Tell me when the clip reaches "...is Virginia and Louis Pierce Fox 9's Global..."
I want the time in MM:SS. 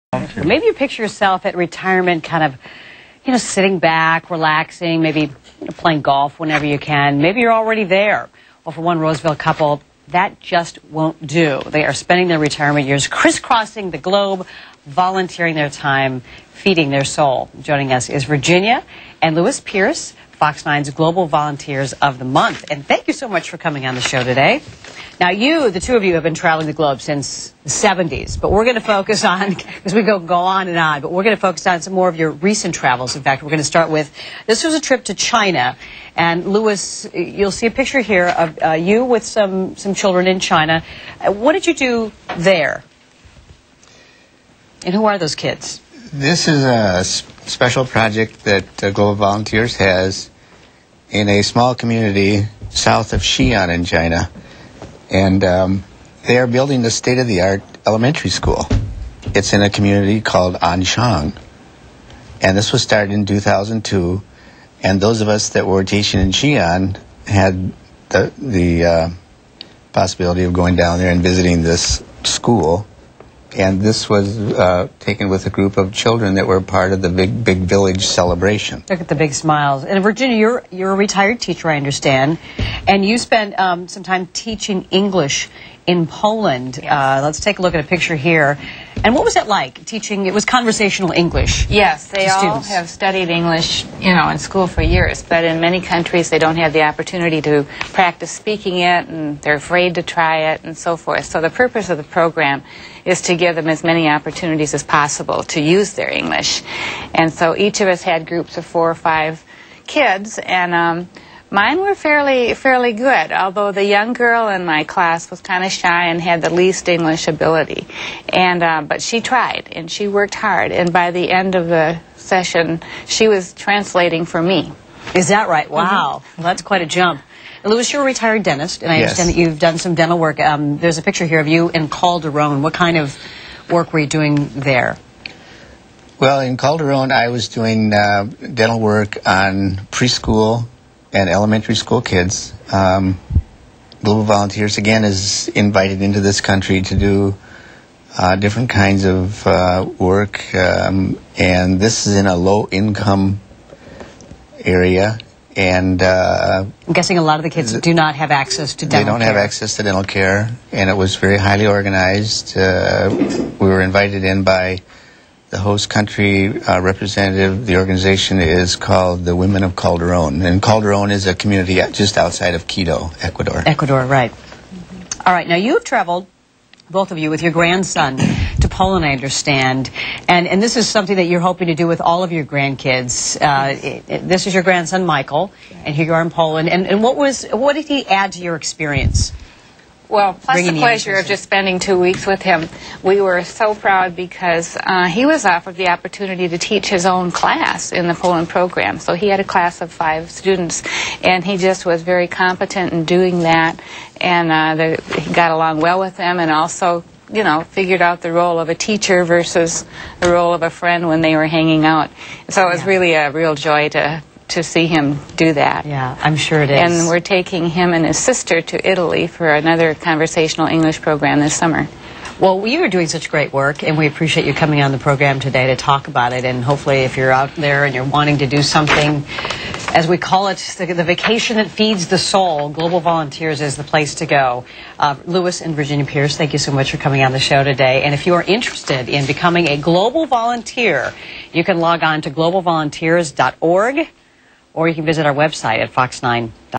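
00:18.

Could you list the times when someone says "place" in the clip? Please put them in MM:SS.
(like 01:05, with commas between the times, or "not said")
03:53.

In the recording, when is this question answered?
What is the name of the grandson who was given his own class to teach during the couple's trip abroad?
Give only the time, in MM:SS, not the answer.
03:05.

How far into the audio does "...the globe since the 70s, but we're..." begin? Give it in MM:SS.
00:26.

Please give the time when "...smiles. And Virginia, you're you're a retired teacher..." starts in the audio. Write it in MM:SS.
01:19.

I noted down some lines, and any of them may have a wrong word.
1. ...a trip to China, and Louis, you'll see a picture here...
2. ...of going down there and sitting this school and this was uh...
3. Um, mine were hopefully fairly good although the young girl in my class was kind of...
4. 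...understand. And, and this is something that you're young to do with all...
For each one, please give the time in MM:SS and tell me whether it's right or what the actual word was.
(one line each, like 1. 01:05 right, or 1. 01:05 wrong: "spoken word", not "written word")
1. 00:34 right
2. 01:10 wrong: "visiting", not "sitting"
3. 01:50 wrong: "fairly", not "hopefully"
4. 02:59 wrong: "hoping", not "young".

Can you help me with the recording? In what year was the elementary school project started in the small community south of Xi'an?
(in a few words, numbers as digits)
2002.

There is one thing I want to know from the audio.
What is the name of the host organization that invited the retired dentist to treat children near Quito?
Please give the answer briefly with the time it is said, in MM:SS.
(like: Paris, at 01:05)
Women of Calderon, at 02:49.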